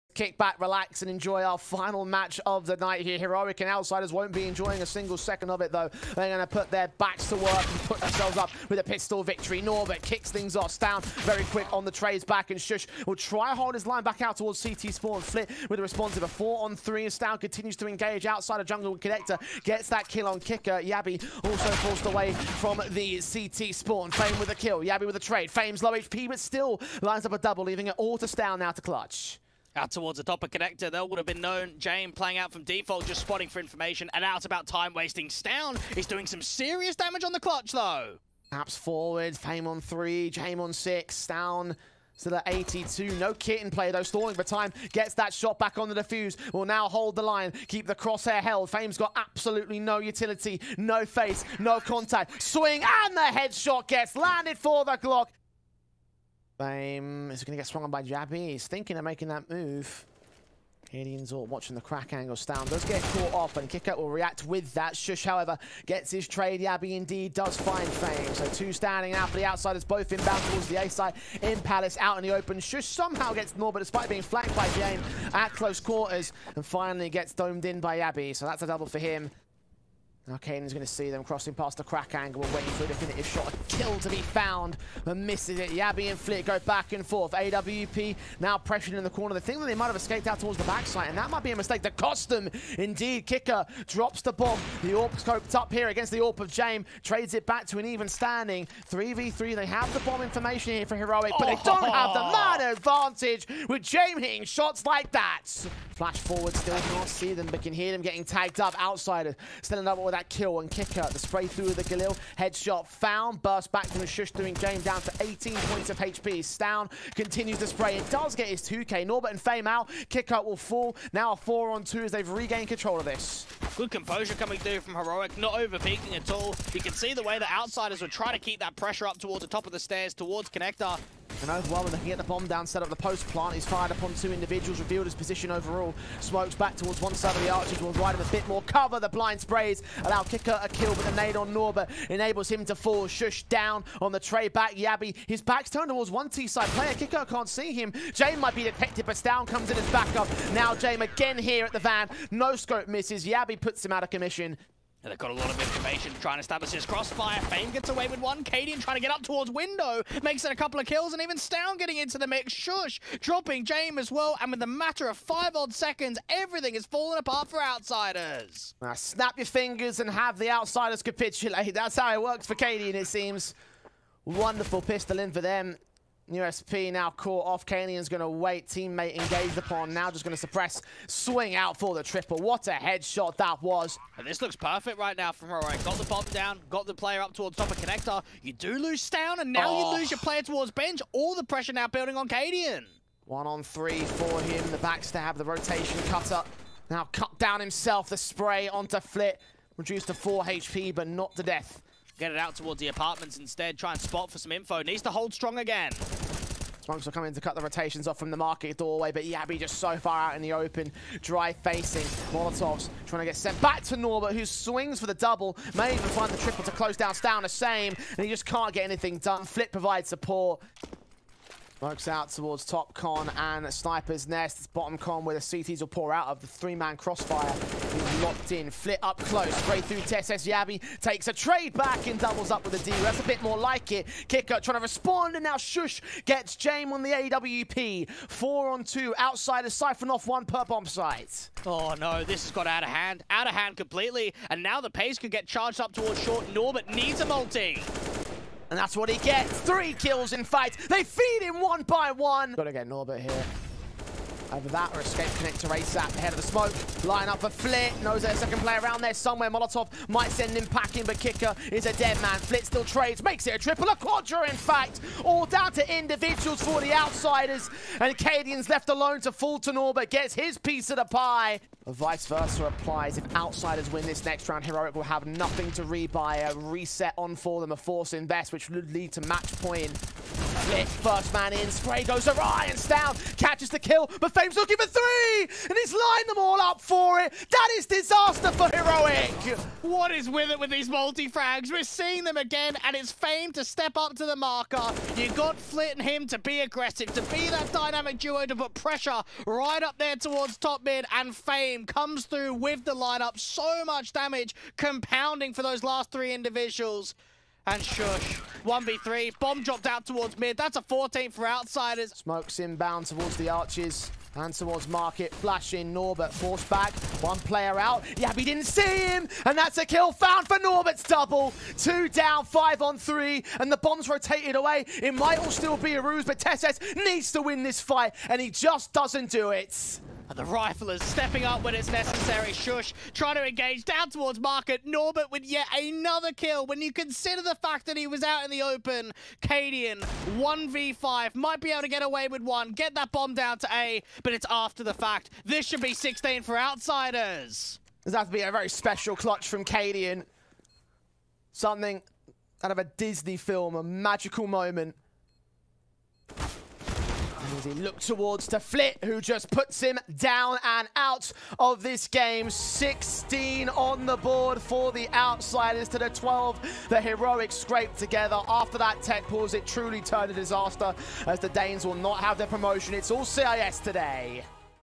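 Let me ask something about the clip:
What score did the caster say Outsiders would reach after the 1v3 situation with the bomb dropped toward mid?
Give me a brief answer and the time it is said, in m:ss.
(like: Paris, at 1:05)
14, at 5:10.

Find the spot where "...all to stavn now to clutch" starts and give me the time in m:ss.
0:27.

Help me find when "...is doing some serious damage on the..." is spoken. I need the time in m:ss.
0:35.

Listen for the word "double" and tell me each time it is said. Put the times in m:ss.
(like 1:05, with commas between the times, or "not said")
0:27, 1:18, 3:35, 3:52, 5:21.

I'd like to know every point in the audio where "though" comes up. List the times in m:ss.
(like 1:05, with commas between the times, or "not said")
0:05, 0:37, 0:43.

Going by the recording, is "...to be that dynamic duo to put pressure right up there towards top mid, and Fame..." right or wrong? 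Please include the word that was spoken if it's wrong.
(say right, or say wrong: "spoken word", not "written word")
right.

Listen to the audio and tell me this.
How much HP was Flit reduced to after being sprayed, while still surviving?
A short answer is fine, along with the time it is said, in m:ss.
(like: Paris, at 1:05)
4, at 3:19.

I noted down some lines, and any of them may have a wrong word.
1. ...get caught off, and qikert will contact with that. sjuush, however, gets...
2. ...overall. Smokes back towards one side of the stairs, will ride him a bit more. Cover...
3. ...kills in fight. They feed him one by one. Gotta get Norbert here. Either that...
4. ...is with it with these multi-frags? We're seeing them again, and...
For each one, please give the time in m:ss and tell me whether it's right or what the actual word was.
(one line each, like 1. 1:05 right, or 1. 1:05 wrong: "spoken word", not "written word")
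1. 1:02 wrong: "react", not "contact"
2. 2:15 wrong: "archers", not "stairs"
3. 4:09 right
4. 4:50 right.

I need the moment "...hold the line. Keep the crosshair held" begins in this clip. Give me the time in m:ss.
0:46.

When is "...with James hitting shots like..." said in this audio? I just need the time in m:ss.
1:43.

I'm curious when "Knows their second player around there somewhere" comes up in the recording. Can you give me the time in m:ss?
4:18.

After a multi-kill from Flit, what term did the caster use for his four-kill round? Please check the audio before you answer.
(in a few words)
A quadra.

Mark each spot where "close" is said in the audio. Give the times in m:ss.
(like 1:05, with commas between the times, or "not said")
1:15, 3:36, 3:49.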